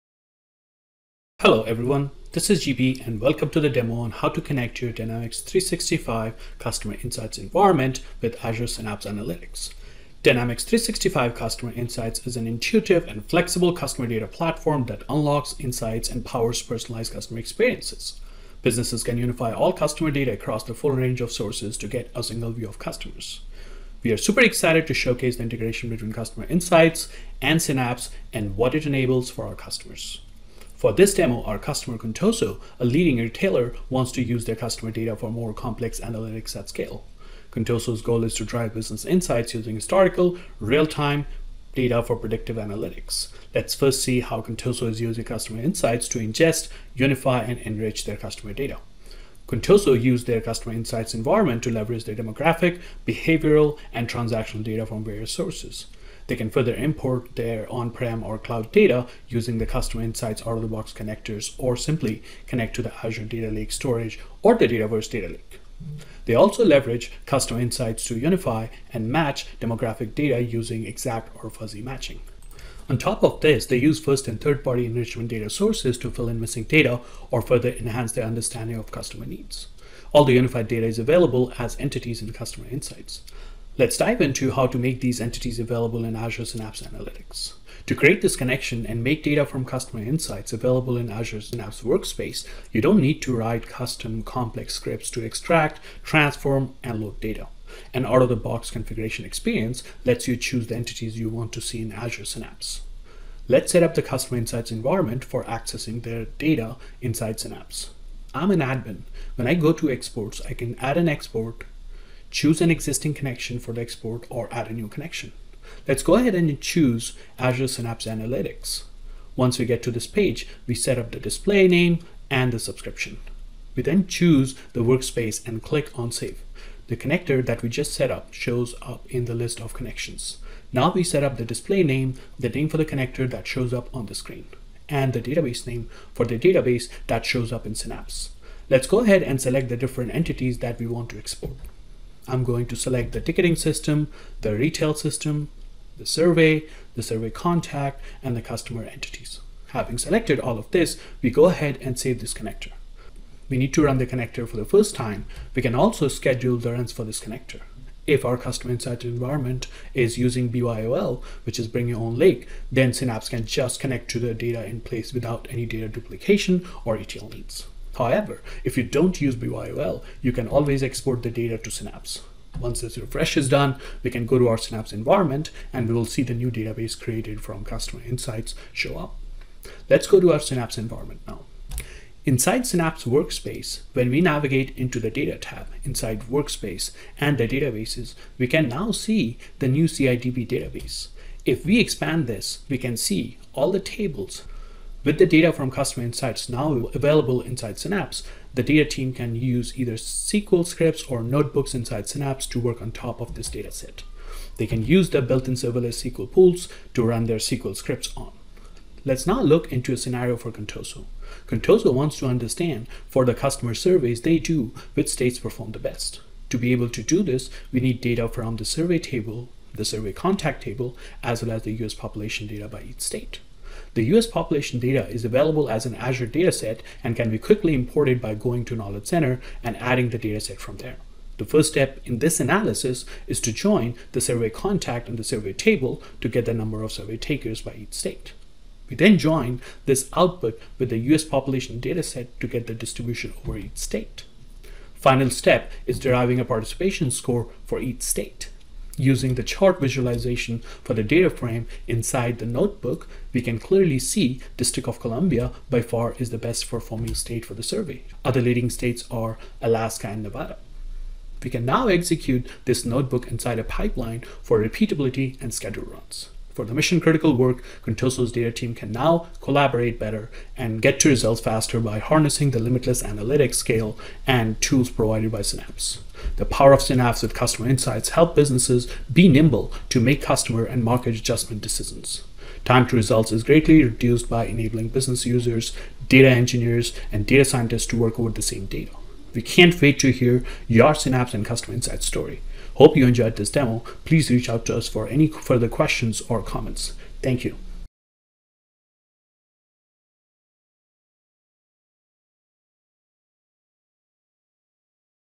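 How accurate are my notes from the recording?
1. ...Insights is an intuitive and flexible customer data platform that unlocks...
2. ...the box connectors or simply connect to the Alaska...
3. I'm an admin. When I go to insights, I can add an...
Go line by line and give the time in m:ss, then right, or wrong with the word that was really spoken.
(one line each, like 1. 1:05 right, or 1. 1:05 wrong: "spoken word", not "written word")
1. 0:11 right
2. 1:00 wrong: "Azure", not "Alaska"
3. 1:48 wrong: "exports", not "insights".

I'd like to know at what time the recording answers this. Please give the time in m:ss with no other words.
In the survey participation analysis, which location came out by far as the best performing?
4:14.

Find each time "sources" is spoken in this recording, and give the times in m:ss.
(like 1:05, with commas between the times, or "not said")
0:21, 0:55, 1:15.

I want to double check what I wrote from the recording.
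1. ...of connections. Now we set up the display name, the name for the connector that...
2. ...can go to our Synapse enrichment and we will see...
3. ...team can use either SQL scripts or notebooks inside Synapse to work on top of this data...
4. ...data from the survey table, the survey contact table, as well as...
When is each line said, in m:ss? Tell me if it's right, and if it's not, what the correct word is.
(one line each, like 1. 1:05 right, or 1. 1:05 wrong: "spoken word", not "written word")
1. 2:09 right
2. 2:54 wrong: "environment", not "enrichment"
3. 3:18 right
4. 3:38 right.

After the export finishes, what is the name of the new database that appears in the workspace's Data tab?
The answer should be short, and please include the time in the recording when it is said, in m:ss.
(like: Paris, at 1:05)
CIDB, at 3:09.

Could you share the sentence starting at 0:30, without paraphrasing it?
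For this demo, our customer Contoso, a leading retailer, wants to use their customer data for more complex analytics at scale.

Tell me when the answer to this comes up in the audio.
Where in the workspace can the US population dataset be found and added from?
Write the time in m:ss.
3:48.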